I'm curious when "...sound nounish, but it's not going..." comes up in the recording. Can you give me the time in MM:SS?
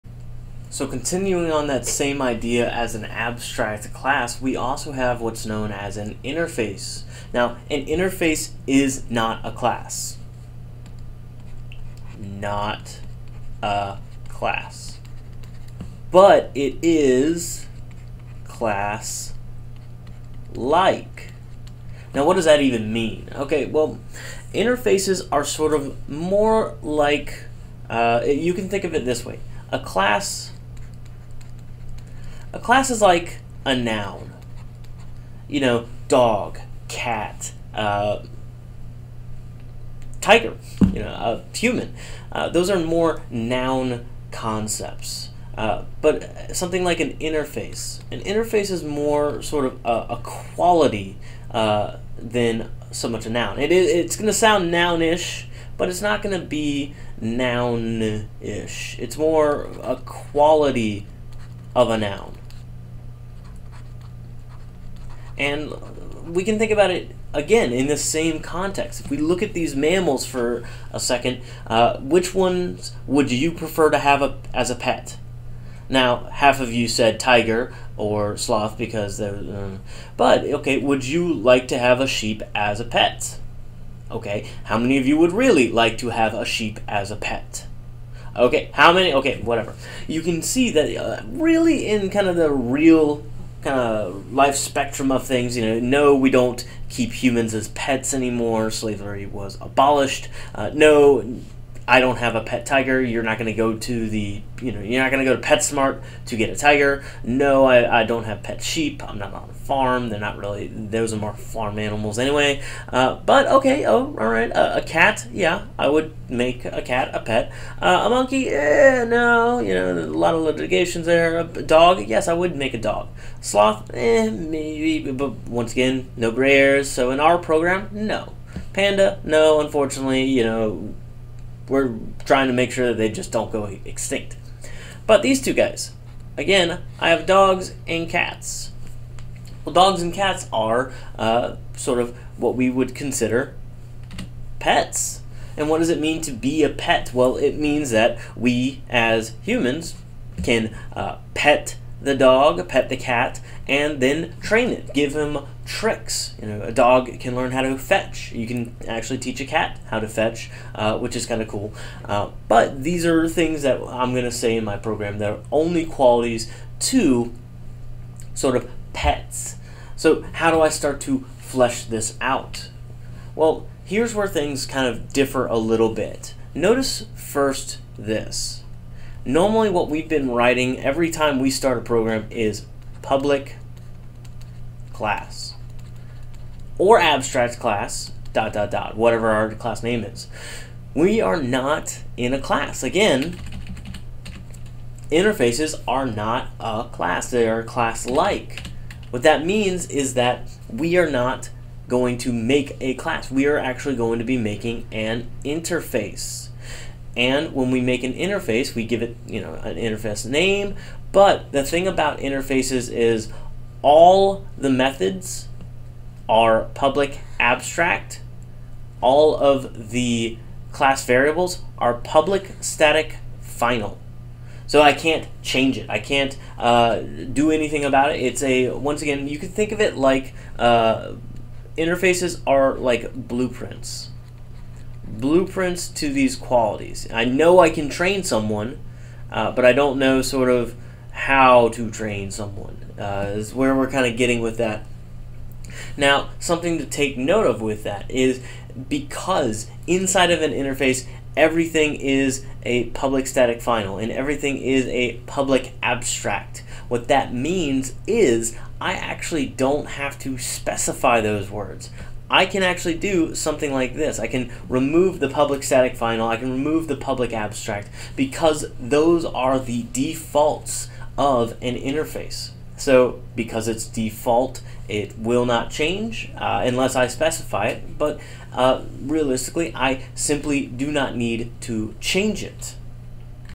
00:54.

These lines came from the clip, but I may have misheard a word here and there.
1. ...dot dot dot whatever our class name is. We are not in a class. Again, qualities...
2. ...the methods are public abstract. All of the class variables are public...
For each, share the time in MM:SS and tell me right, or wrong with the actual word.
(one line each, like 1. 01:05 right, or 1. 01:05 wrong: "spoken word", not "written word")
1. 03:08 wrong: "interfaces", not "qualities"
2. 03:34 right.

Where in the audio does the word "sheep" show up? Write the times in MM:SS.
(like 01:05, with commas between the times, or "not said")
01:22, 01:26, 01:48.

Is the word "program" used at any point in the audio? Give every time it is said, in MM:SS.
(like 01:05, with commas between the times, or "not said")
02:07, 02:44, 03:01.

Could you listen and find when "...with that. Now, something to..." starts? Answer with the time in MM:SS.
04:04.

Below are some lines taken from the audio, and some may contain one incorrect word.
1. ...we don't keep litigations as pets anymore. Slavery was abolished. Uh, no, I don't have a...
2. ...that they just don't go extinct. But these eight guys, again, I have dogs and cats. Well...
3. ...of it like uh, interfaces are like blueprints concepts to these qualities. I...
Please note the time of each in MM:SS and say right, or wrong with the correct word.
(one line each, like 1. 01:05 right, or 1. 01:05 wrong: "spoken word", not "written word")
1. 01:36 wrong: "humans", not "litigations"
2. 02:12 wrong: "two", not "eight"
3. 03:49 wrong: "blueprints", not "concepts".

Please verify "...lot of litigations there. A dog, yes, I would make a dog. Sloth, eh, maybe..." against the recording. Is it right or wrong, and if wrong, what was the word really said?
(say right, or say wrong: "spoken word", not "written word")
right.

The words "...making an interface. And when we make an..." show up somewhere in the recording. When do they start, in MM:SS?
03:24.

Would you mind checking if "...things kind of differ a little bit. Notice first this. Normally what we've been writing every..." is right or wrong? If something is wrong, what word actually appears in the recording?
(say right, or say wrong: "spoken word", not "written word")
right.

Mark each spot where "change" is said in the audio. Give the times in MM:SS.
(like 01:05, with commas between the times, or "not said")
03:45, 04:35, 04:41.